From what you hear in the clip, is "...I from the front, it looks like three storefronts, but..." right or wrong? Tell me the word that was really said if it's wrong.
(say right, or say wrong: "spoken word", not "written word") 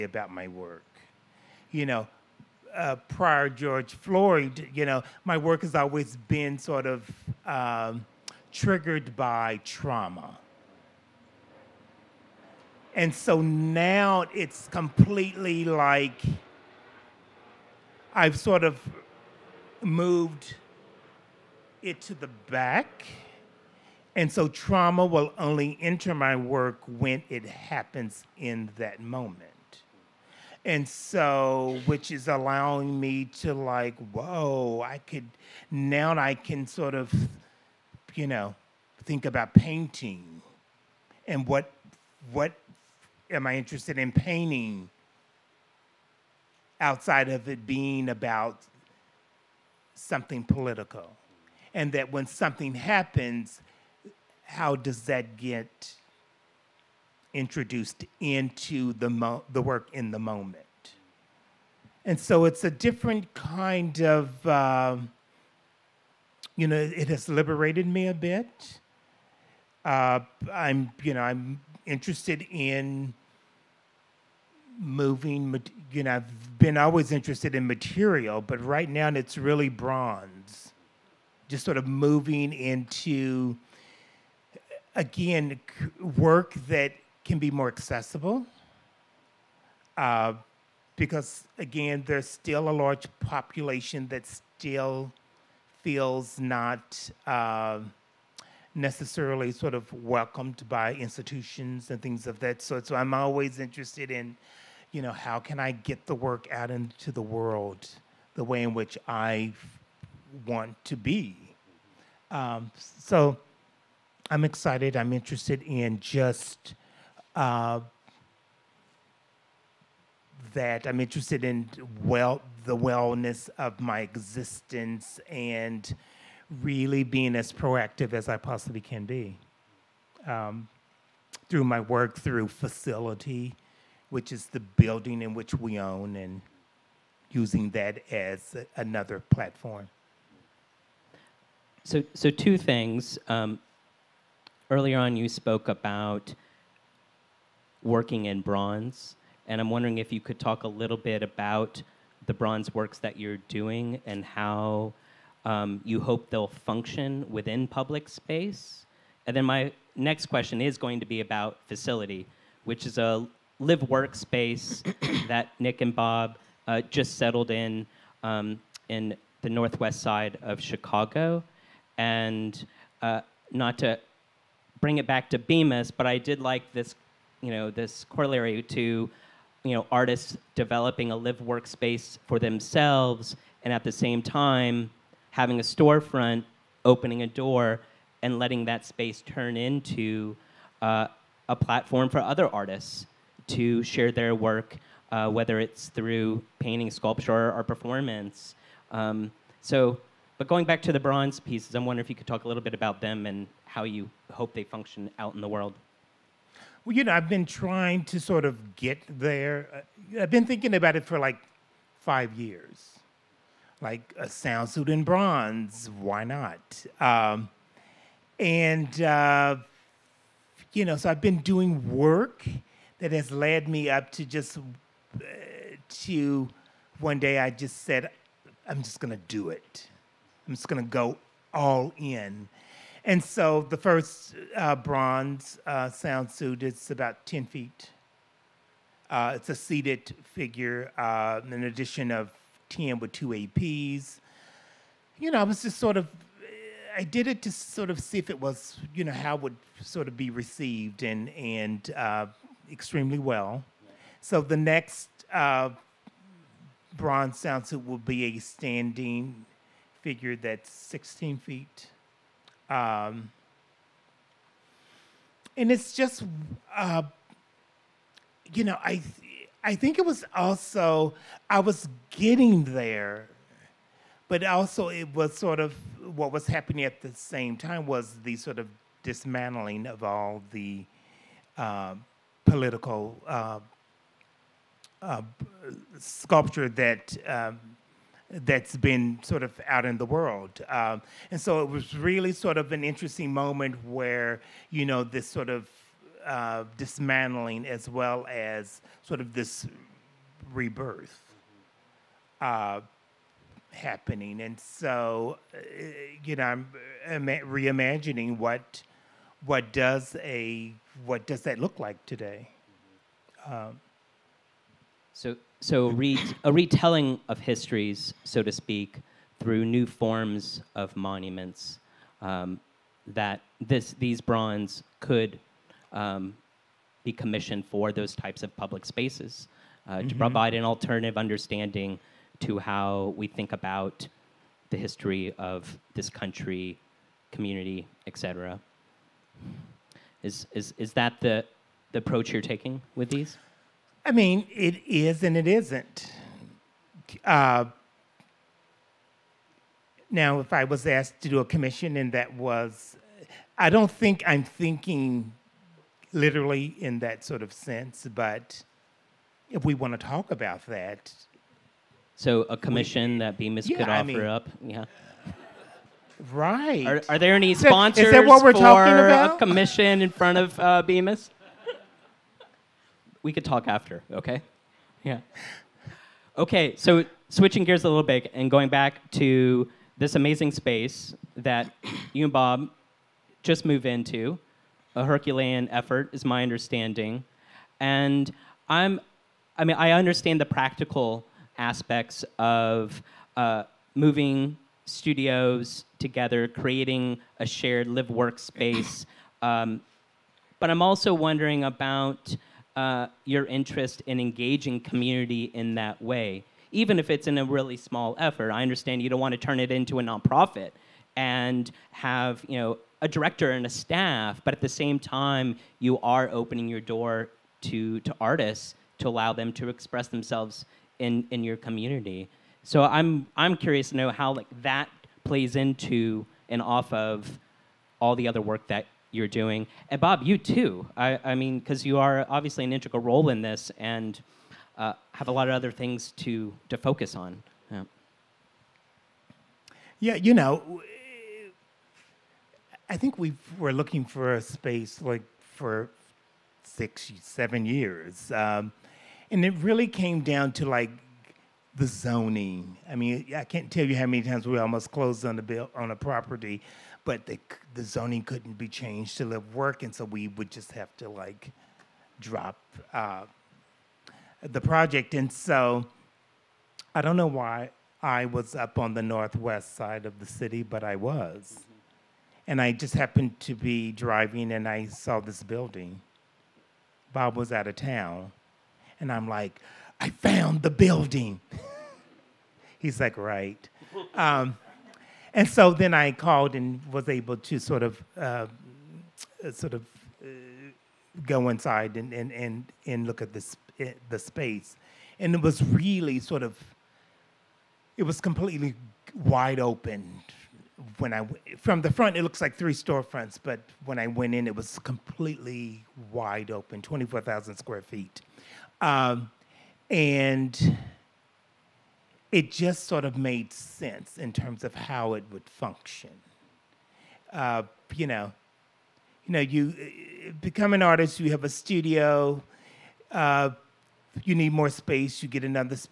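right.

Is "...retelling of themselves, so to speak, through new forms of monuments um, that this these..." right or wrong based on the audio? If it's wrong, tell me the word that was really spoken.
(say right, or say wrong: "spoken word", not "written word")
wrong: "histories", not "themselves".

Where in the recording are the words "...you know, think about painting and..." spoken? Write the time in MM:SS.
00:38.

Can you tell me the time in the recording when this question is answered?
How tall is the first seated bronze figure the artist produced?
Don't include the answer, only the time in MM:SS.
03:57.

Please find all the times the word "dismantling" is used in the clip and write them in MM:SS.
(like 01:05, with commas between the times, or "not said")
04:39, 04:56.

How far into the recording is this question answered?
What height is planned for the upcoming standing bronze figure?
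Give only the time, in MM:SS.
04:20.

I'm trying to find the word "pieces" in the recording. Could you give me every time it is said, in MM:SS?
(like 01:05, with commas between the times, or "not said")
03:21.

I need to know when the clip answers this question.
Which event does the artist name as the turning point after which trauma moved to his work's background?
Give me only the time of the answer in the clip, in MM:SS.
00:03.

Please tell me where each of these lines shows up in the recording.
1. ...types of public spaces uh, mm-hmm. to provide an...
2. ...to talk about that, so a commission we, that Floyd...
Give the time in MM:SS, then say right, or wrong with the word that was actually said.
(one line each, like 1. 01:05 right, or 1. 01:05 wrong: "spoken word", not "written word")
1. 05:28 right
2. 05:59 wrong: "Bemis", not "Floyd".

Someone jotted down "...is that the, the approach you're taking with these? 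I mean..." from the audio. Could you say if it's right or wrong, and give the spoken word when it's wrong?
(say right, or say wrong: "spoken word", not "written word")
right.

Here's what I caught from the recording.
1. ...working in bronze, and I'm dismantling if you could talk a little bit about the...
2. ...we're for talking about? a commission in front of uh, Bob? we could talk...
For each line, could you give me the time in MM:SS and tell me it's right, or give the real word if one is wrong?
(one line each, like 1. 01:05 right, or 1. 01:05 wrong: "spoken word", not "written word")
1. 02:27 wrong: "wondering", not "dismantling"
2. 06:08 wrong: "Bemis", not "Bob".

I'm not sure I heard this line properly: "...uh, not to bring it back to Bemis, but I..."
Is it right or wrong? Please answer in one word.
right.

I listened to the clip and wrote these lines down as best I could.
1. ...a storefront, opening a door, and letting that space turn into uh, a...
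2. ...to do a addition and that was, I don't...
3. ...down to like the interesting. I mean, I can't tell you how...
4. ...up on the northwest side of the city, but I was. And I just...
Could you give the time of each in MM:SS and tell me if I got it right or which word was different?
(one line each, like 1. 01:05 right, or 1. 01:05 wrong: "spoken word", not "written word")
1. 03:05 right
2. 05:51 wrong: "commission", not "addition"
3. 07:30 wrong: "zoning", not "interesting"
4. 07:48 right.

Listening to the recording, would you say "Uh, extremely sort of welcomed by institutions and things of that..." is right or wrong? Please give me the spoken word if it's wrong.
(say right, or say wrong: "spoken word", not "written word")
wrong: "necessarily", not "extremely".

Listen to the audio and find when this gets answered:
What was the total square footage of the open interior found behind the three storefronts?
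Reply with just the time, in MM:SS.
08:26.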